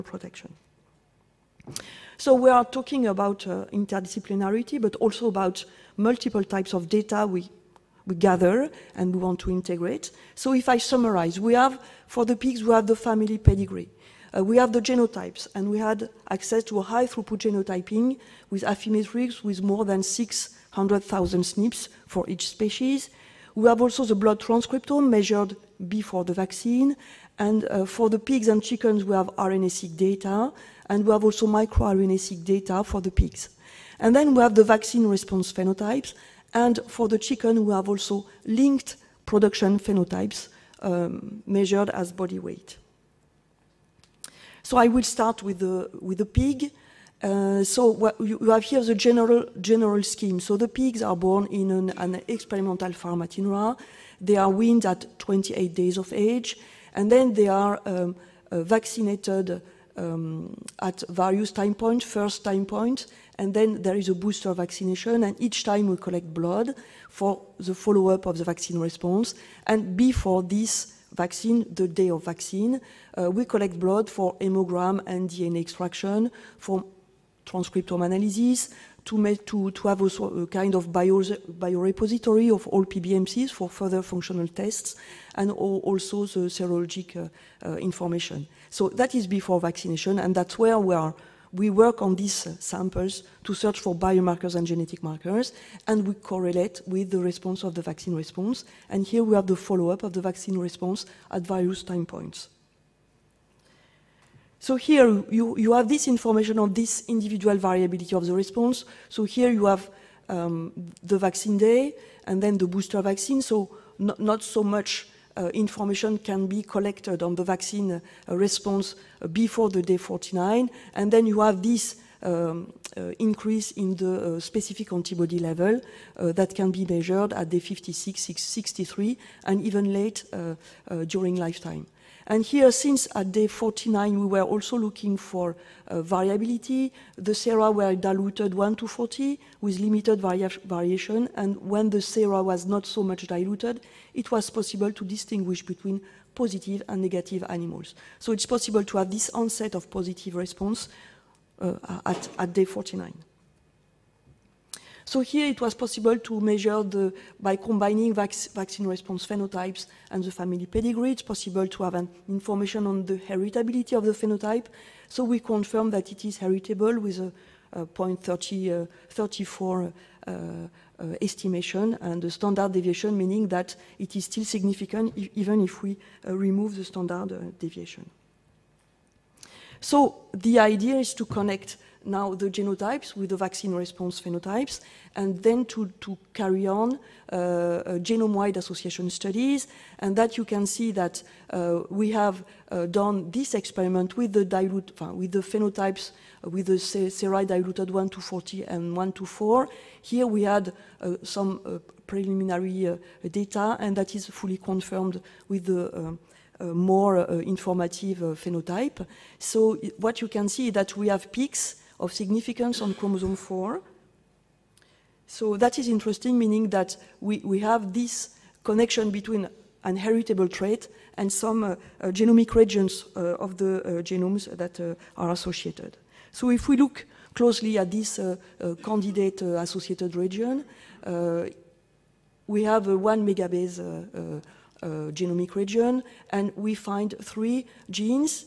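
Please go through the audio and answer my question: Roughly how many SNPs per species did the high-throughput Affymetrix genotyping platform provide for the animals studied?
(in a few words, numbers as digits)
600,000.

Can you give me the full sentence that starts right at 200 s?
Here we had some preliminary data, and that is fully confirmed with the uh, more uh, informative uh, phenotype.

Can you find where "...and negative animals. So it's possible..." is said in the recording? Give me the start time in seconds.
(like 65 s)
146 s.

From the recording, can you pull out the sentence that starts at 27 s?
And uh, for the pigs and chickens, we have RNA-seq data, and we have also microRNA-seq data for the pigs.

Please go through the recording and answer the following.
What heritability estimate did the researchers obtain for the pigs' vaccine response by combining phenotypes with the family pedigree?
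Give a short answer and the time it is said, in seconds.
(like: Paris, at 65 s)
0.34, at 167 s.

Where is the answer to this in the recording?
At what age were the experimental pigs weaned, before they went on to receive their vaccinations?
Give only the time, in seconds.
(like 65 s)
55 s.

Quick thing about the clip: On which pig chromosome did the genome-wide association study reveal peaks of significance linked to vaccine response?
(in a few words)
Chromosome 4.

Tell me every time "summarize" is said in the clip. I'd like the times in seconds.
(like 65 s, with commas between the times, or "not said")
10 s.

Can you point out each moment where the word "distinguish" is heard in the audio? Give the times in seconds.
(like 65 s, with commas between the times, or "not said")
145 s.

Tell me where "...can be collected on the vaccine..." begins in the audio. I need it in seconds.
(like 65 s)
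116 s.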